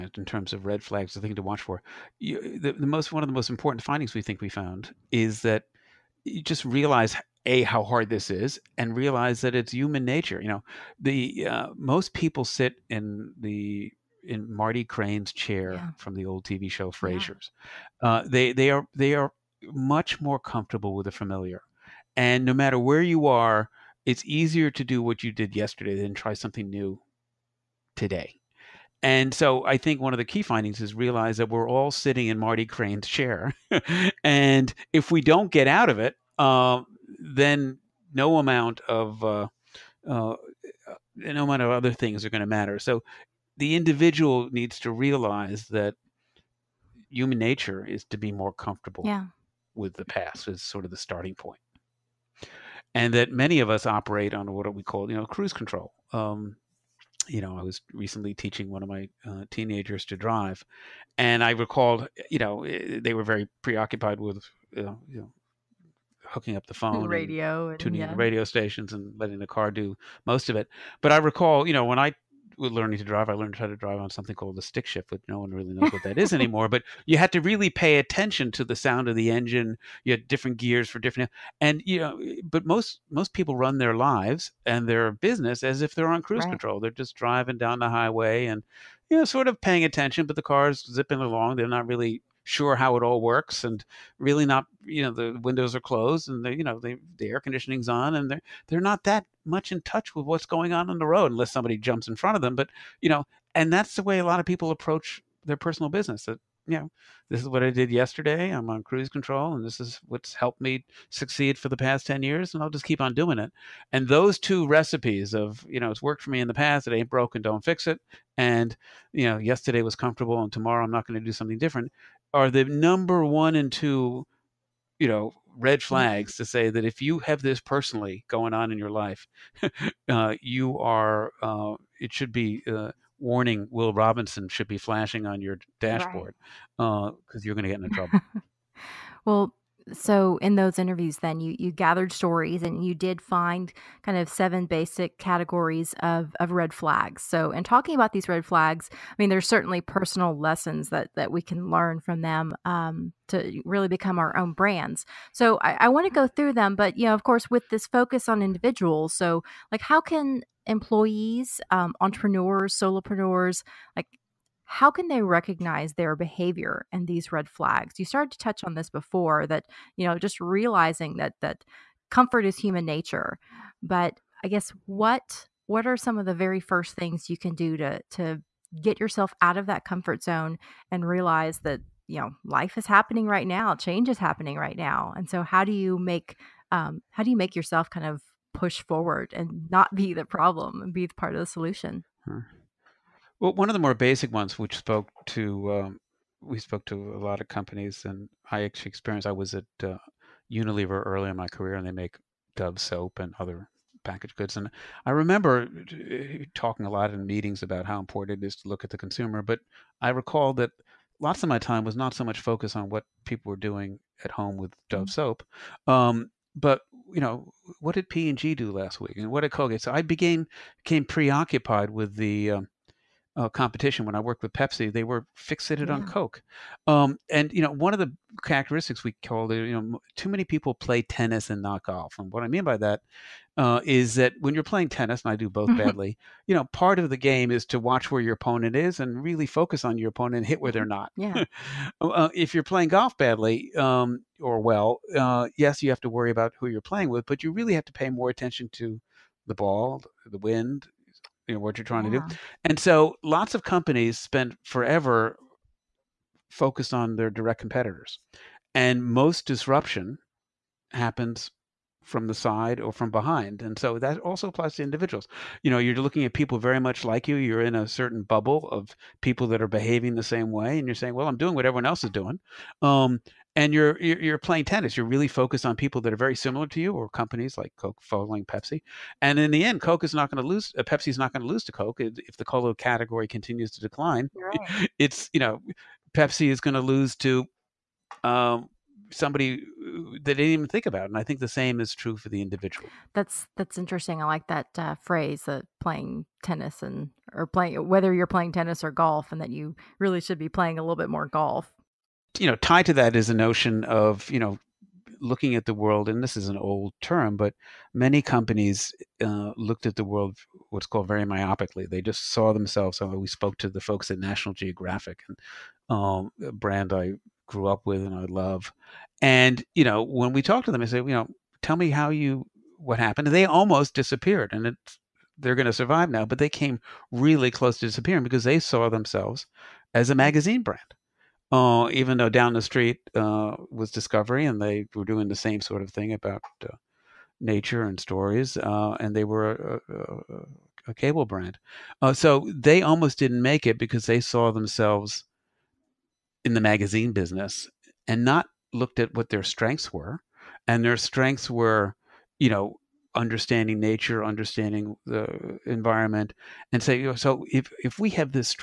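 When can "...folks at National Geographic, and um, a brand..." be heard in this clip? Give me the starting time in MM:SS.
05:13.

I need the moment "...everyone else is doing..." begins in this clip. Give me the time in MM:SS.
04:31.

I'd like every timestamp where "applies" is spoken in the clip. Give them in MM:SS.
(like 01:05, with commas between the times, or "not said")
04:24.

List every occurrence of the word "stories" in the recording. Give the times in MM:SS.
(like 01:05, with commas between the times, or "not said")
02:22, 05:38.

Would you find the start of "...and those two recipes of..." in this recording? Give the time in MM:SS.
01:53.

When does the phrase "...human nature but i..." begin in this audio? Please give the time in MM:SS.
02:52.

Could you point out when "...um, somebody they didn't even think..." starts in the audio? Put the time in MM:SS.
04:48.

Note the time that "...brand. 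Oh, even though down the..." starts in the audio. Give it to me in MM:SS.
05:30.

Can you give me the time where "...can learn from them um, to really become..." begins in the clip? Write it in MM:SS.
02:31.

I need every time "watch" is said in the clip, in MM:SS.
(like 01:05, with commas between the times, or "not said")
00:01, 03:57.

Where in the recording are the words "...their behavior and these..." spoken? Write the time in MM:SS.
02:45.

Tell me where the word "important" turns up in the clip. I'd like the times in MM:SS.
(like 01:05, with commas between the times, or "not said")
00:03, 03:28.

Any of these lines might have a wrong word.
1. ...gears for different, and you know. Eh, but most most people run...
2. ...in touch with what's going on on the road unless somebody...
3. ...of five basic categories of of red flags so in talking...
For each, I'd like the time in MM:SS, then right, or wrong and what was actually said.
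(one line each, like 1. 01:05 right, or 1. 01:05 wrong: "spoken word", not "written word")
1. 01:20 right
2. 01:39 right
3. 02:24 wrong: "seven", not "five".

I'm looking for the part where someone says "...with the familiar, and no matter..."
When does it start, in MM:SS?
00:20.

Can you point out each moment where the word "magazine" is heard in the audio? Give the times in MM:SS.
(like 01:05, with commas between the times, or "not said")
05:30, 05:46.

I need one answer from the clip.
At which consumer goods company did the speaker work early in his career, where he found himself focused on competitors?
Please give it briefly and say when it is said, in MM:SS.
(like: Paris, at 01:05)
Unilever, at 03:20.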